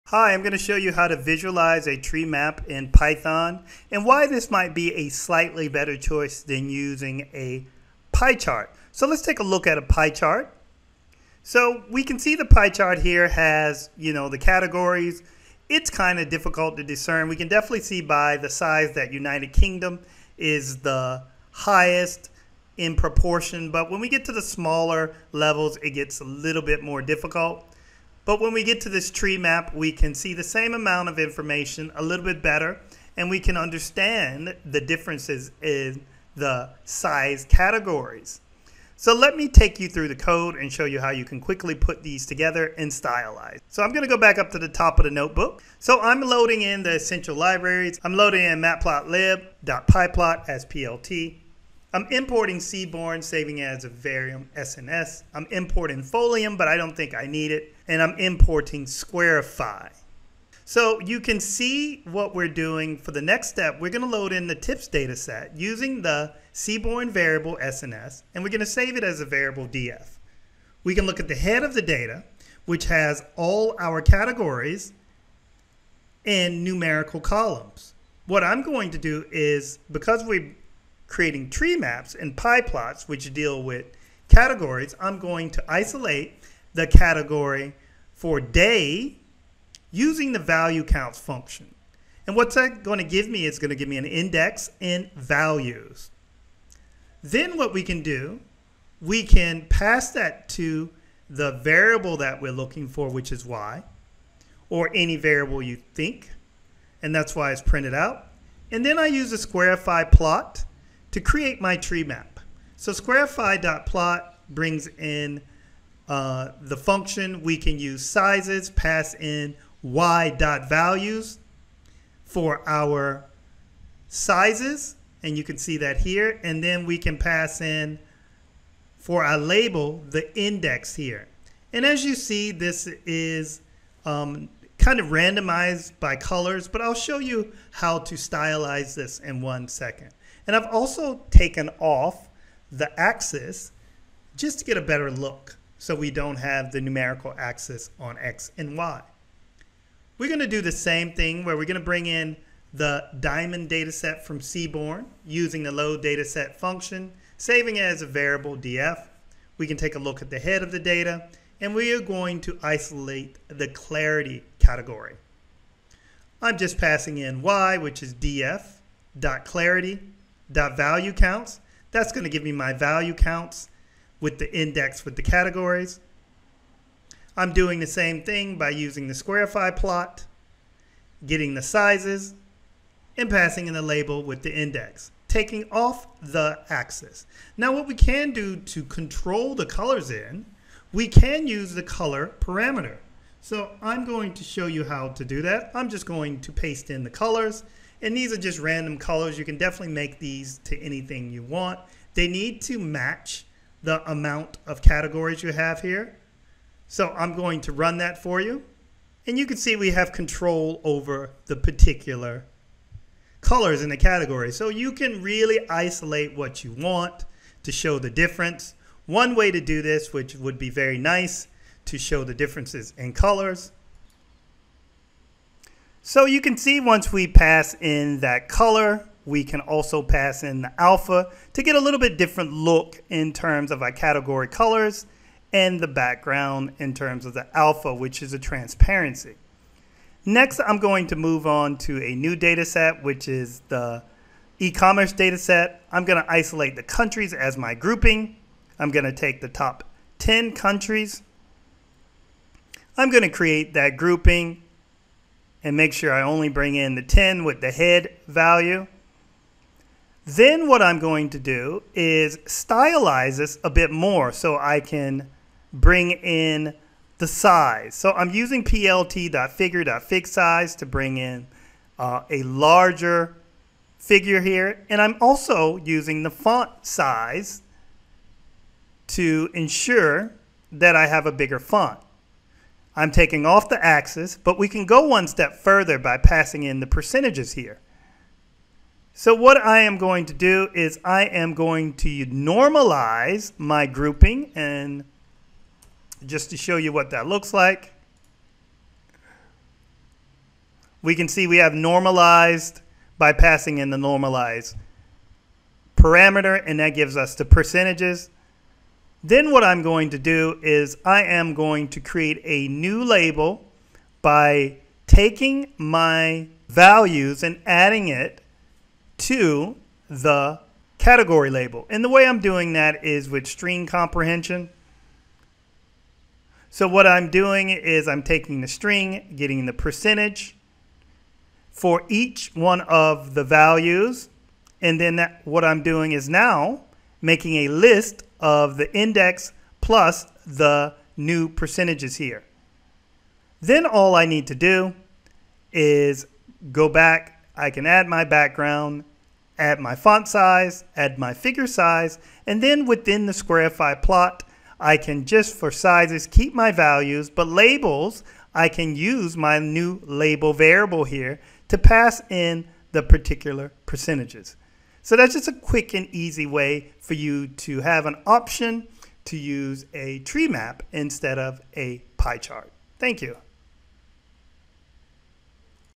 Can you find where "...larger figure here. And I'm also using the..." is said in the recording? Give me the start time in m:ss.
4:32.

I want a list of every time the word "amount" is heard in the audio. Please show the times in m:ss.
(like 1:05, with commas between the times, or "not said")
0:30, 3:24.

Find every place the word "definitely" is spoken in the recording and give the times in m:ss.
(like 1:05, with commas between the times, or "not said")
0:17, 3:19.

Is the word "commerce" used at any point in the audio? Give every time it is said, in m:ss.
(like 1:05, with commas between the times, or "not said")
4:04.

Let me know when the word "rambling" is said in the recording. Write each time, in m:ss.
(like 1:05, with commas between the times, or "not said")
not said.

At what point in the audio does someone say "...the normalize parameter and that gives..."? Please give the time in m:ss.
5:03.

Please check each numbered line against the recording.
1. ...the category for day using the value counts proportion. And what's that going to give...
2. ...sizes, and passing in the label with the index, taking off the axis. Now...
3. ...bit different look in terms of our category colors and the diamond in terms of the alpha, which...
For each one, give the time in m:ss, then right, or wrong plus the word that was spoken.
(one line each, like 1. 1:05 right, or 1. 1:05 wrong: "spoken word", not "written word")
1. 1:26 wrong: "function", not "proportion"
2. 3:01 right
3. 3:51 wrong: "background", not "diamond".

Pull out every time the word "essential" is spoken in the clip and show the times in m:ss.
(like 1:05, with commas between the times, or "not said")
0:46.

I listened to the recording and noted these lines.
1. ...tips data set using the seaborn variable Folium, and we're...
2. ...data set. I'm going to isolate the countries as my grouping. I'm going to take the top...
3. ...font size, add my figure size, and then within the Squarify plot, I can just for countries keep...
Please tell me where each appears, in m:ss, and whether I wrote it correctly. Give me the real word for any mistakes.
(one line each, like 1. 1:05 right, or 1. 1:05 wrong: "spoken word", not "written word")
1. 1:04 wrong: "SNS", not "Folium"
2. 4:05 right
3. 5:49 wrong: "sizes", not "countries".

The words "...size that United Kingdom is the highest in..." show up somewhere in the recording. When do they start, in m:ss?
0:18.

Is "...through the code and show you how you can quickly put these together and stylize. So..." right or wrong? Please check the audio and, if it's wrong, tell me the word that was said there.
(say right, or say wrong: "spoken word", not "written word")
right.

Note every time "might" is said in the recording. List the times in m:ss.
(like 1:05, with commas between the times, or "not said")
0:04.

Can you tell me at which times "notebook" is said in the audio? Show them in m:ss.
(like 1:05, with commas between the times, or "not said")
0:45.